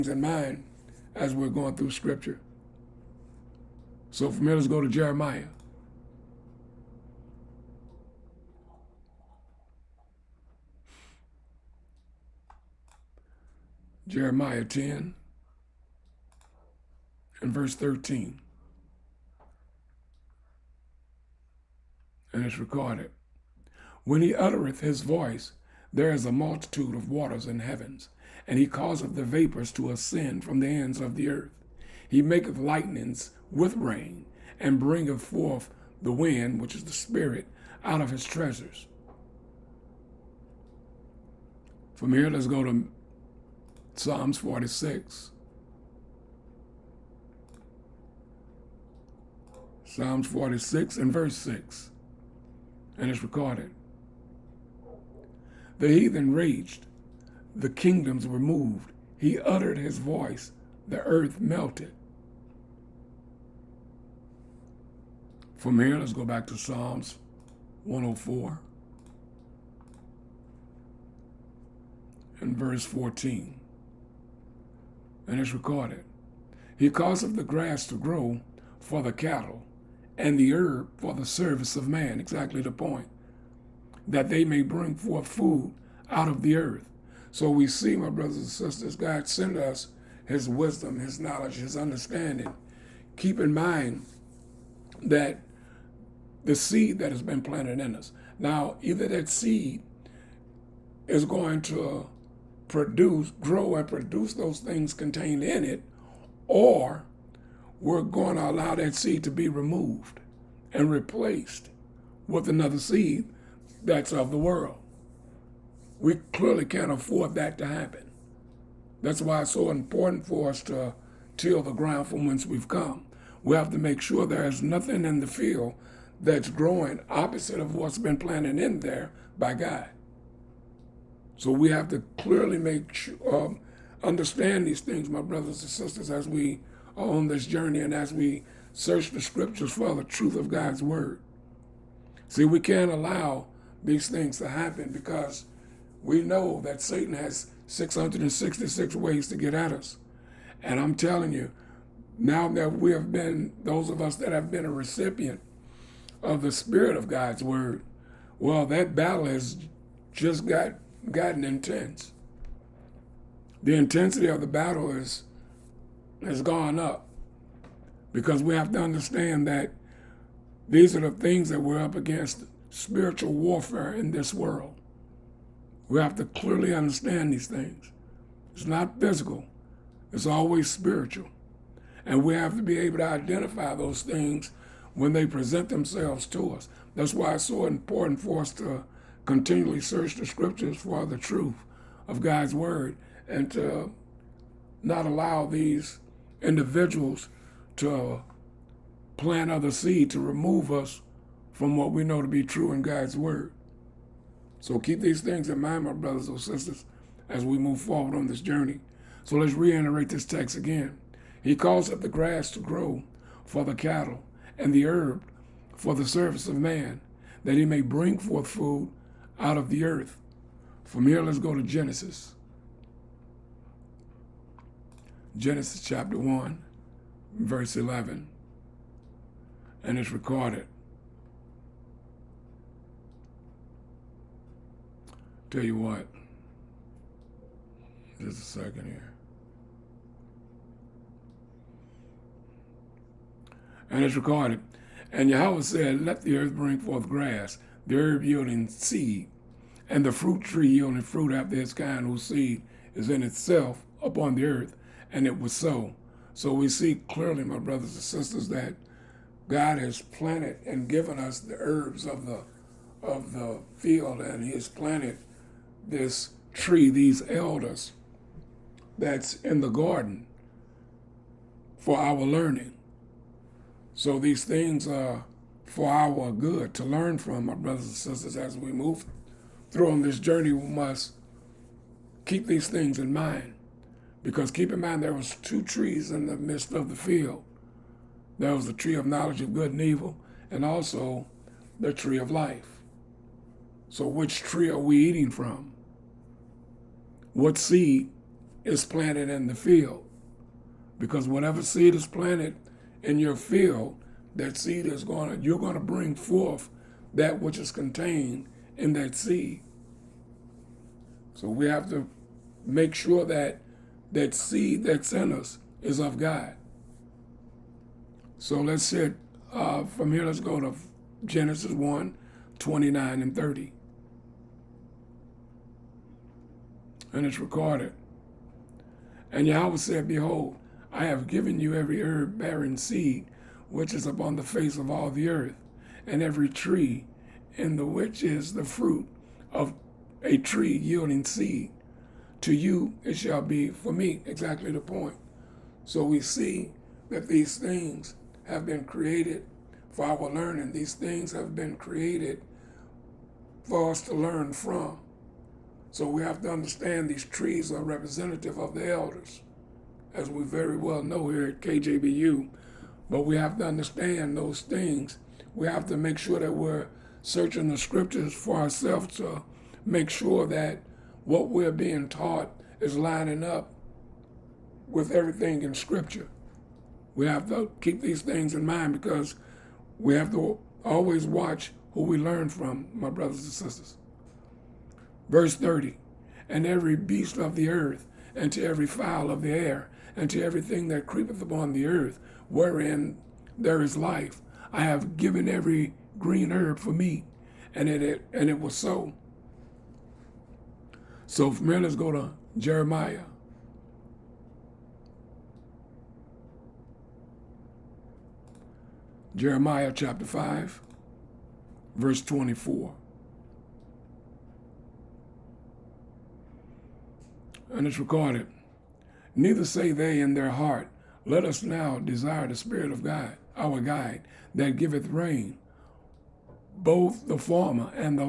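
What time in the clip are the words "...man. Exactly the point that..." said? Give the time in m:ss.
1:21.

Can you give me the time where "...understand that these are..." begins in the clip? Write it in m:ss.
2:48.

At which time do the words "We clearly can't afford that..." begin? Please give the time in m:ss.
1:55.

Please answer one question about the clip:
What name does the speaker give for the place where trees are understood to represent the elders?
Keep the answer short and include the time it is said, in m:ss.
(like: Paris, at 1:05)
KJBU, at 6:01.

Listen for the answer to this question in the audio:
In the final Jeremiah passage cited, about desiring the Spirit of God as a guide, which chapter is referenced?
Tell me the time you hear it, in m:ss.
6:49.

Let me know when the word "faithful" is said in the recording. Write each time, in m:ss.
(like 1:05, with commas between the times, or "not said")
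not said.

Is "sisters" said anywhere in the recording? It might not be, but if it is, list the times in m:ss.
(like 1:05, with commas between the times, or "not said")
1:28, 2:15, 3:26, 4:18, 4:37, 6:23.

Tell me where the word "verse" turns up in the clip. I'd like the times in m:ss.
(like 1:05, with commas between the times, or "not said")
0:17, 0:51, 1:12, 3:47, 6:25, 6:51.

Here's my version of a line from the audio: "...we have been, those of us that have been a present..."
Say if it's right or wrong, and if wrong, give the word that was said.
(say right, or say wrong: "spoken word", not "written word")
wrong: "recipient", not "present".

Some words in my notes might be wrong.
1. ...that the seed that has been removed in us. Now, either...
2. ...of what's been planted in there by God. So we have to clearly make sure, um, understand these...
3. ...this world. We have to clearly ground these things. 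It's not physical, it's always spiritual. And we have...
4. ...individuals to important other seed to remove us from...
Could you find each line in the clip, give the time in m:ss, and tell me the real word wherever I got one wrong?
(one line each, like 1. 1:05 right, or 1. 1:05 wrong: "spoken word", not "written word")
1. 1:35 wrong: "planted", not "removed"
2. 2:07 right
3. 2:54 wrong: "understand", not "ground"
4. 3:16 wrong: "plant", not "important".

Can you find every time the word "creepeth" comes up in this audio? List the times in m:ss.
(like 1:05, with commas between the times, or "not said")
6:31.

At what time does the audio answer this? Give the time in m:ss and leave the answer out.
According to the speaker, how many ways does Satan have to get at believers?
2:27.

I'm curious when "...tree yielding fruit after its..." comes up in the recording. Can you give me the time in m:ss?
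4:10.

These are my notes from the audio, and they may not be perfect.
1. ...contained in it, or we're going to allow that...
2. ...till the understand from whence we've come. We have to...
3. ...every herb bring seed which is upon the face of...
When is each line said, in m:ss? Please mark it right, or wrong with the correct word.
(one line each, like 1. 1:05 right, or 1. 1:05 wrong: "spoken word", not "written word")
1. 1:44 right
2. 2:01 wrong: "ground", not "understand"
3. 5:31 wrong: "bearing", not "bring".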